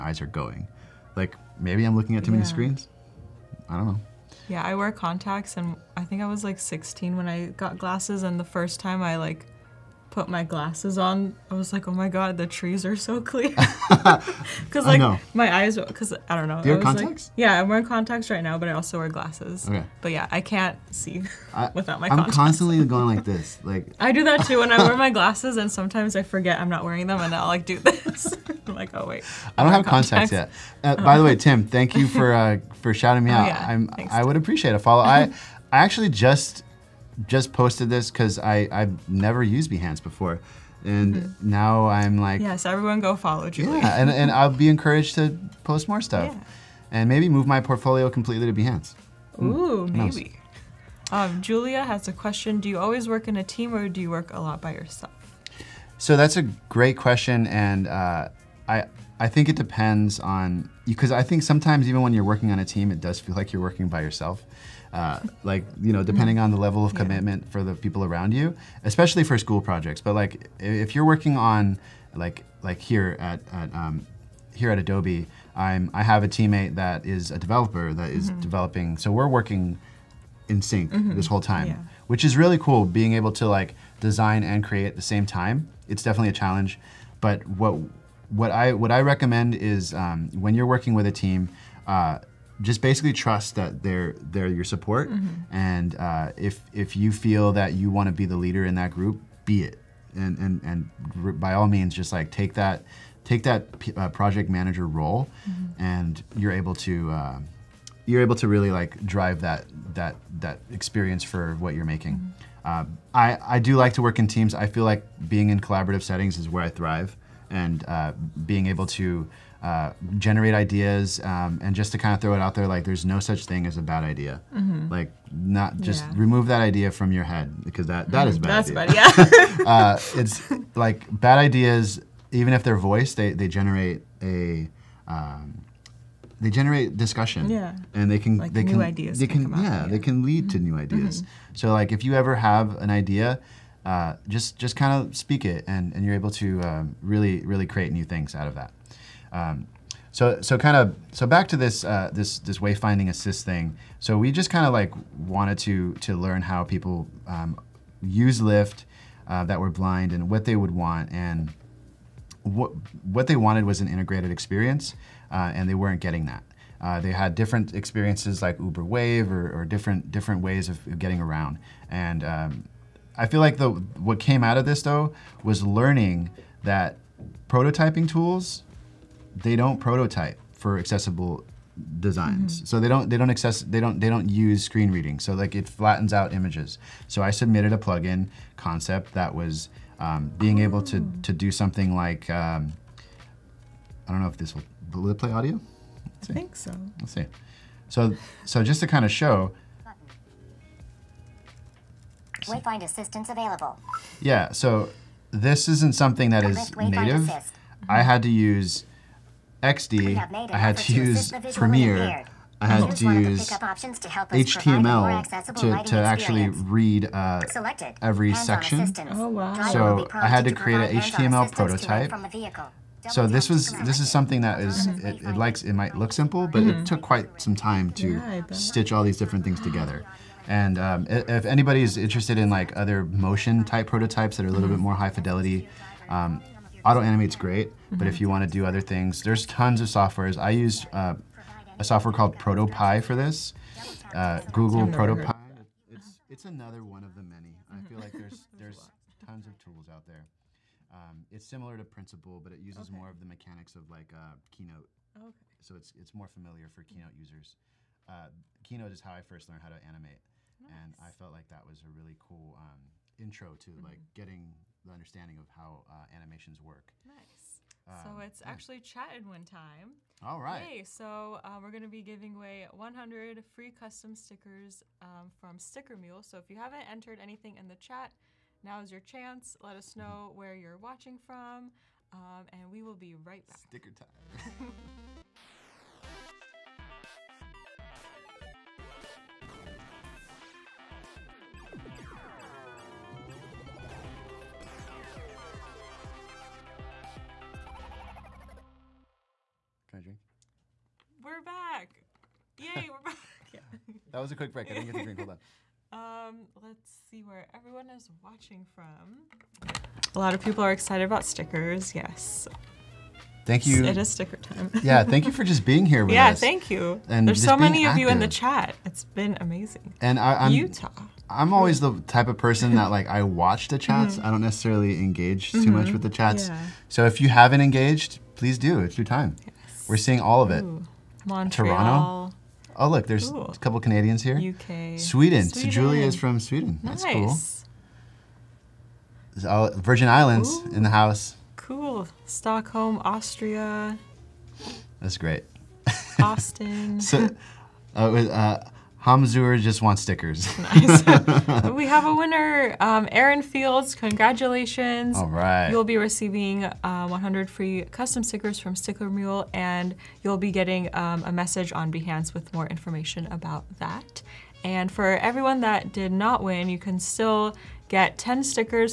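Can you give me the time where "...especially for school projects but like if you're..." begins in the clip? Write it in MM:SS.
01:08.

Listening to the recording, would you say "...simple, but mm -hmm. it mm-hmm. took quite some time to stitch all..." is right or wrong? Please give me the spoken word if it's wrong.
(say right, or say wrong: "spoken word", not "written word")
right.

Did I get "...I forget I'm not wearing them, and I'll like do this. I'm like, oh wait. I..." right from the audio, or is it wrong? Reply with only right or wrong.
right.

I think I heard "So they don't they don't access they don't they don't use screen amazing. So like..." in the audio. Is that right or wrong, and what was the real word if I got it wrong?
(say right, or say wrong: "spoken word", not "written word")
wrong: "reading", not "amazing".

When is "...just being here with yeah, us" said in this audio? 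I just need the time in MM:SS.
05:15.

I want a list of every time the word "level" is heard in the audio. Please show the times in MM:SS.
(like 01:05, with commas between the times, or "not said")
01:06.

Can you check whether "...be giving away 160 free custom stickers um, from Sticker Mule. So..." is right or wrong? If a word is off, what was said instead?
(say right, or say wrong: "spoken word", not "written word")
wrong: "100", not "160".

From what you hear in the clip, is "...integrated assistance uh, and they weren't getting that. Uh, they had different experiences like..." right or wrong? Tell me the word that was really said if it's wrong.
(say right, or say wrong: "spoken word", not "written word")
wrong: "experience", not "assistance".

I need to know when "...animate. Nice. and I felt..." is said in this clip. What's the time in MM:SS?
04:19.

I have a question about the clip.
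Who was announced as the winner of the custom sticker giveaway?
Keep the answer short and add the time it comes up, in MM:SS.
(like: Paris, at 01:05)
Aaron Fields, at 05:53.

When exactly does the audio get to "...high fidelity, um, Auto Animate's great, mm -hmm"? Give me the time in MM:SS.
03:55.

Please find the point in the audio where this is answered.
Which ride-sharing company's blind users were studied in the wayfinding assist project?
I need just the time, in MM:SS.
02:38.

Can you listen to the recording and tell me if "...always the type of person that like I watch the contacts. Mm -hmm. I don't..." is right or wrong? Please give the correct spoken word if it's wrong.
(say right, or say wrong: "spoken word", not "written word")
wrong: "chats", not "contacts".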